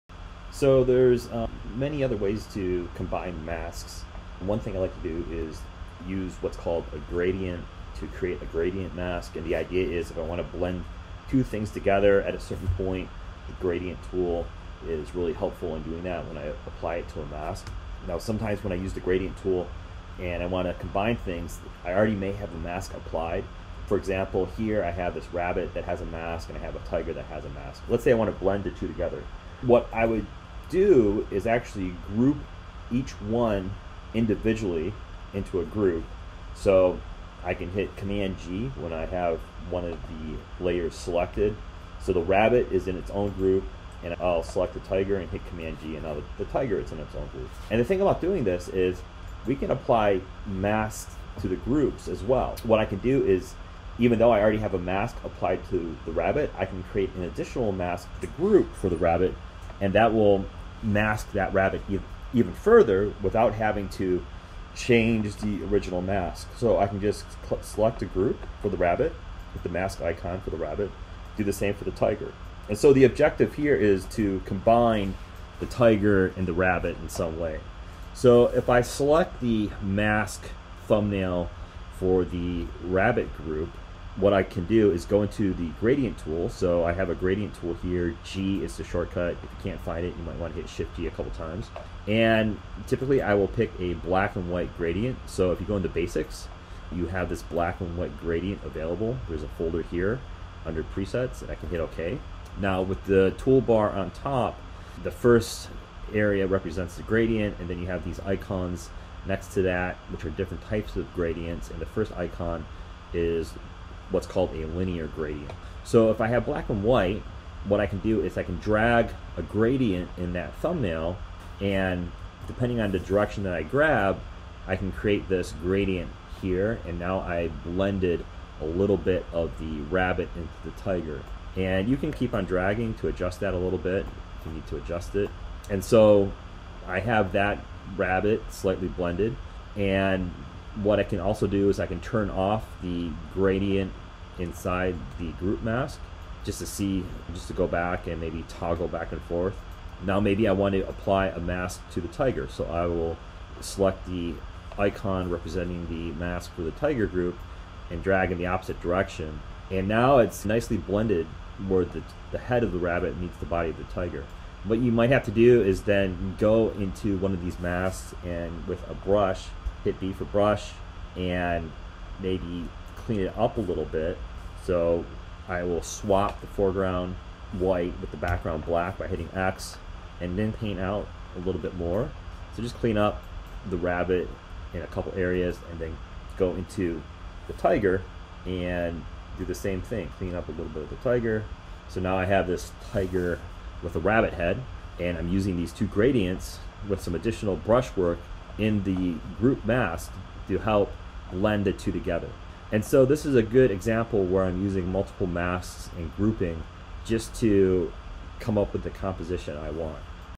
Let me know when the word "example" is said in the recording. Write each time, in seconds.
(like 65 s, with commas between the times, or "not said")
23 s, 203 s.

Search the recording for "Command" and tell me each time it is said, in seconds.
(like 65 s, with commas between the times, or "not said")
37 s, 45 s.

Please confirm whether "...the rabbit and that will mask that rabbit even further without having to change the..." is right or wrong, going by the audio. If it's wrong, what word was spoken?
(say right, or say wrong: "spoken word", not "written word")
right.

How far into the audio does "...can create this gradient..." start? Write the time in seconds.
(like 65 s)
124 s.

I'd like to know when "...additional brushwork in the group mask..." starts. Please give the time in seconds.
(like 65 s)
197 s.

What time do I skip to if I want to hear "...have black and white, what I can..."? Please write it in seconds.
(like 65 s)
116 s.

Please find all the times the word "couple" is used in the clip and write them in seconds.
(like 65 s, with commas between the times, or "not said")
91 s, 184 s.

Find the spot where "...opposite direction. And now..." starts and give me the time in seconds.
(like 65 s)
158 s.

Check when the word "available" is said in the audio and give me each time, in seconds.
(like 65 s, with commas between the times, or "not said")
98 s.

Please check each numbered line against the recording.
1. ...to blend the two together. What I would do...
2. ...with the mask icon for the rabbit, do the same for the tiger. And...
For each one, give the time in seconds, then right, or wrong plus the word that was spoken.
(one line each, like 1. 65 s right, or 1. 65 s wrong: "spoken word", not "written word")
1. 28 s right
2. 69 s right.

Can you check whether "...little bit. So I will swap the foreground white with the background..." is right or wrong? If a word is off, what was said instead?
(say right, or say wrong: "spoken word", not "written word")
right.